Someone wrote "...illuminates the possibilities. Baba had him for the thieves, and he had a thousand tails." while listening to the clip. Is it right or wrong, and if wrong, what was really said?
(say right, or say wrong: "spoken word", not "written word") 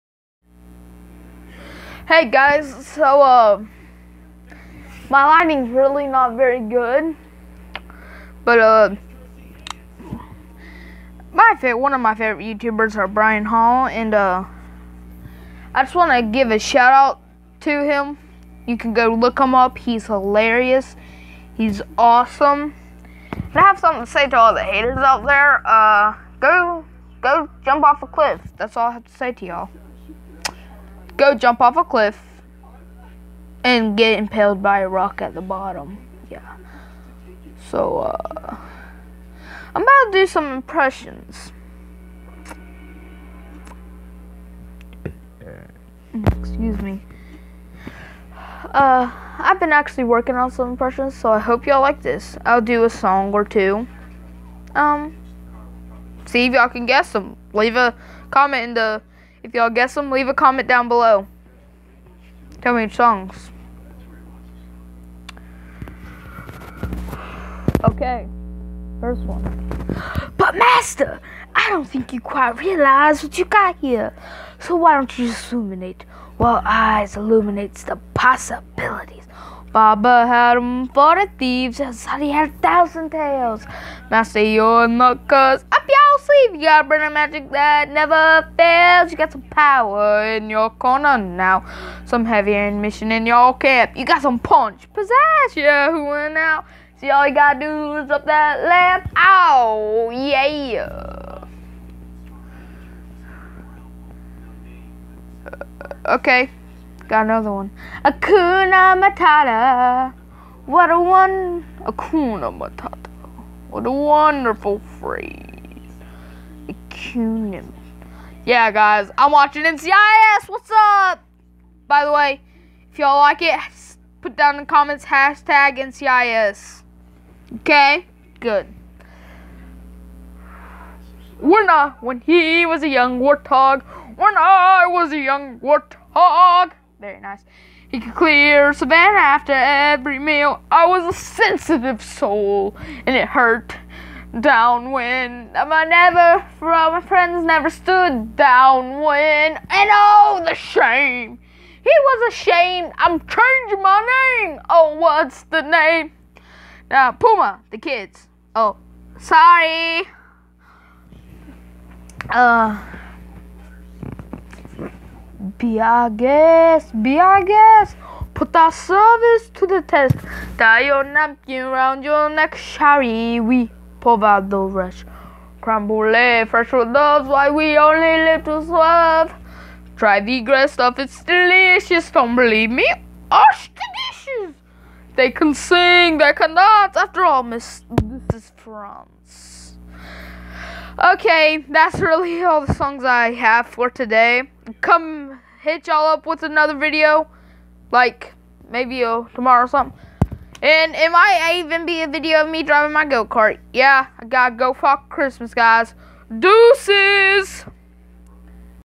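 right.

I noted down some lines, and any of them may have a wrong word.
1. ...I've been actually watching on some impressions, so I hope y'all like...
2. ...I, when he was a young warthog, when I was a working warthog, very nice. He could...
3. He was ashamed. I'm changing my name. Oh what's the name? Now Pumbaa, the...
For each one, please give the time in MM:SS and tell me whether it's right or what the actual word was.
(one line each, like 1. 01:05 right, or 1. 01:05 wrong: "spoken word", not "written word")
1. 00:49 wrong: "working", not "watching"
2. 02:11 wrong: "young", not "working"
3. 02:31 right.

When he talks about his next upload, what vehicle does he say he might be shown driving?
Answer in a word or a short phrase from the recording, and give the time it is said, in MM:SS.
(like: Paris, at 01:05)
go-kart, at 03:23.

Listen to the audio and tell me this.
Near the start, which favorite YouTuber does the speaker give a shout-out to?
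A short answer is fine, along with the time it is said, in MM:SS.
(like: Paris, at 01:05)
Brian Hall, at 00:13.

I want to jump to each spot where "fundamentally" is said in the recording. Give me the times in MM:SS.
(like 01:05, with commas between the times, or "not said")
not said.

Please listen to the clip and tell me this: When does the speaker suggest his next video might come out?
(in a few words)
tomorrow.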